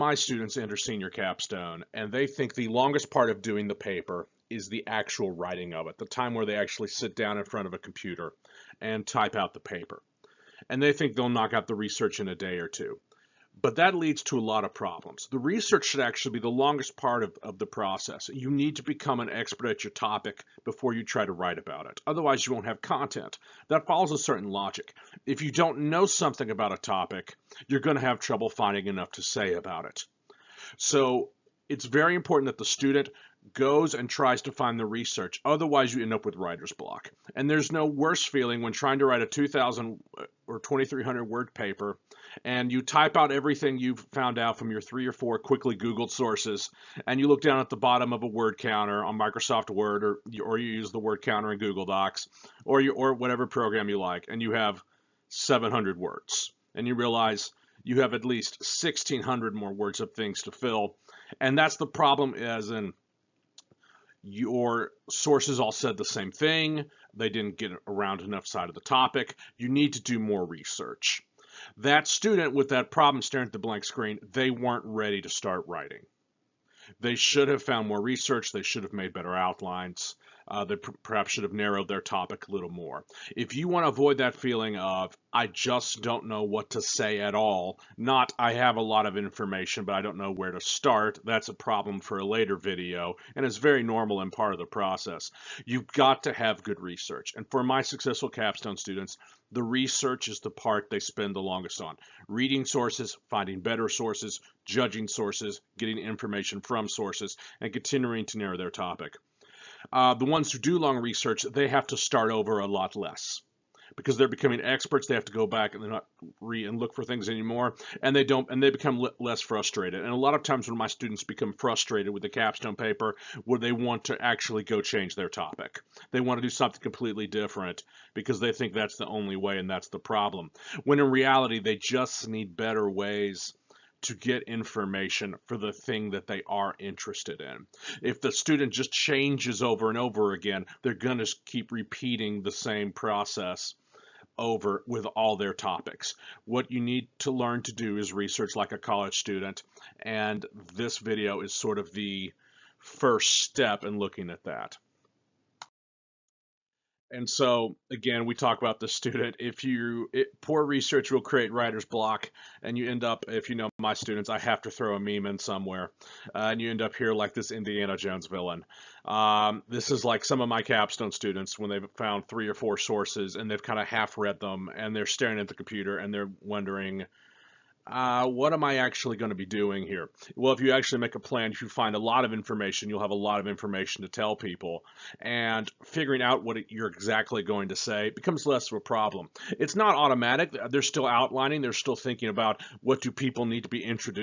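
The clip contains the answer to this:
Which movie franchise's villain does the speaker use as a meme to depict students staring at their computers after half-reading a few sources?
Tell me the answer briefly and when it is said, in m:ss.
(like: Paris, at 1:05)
Indiana Jones, at 2:47.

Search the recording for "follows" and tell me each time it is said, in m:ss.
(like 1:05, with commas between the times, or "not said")
0:23.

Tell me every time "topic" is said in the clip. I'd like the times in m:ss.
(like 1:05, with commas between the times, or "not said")
0:19, 0:26, 1:08, 1:22, 1:48, 2:05, 2:25.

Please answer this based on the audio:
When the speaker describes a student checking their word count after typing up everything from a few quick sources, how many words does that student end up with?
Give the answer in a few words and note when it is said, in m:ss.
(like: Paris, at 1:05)
700, at 0:55.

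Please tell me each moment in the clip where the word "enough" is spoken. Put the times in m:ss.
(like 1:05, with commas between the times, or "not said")
0:28, 1:08.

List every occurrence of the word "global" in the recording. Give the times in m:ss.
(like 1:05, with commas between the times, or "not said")
not said.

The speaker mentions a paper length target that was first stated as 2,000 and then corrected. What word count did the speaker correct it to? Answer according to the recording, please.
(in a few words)
2,300.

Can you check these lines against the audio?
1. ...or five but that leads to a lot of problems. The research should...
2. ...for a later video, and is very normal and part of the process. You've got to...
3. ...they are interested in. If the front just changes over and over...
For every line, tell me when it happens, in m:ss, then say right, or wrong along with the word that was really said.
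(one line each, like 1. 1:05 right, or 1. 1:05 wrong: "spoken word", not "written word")
1. 0:12 wrong: "two", not "five"
2. 1:32 right
3. 2:16 wrong: "student", not "front".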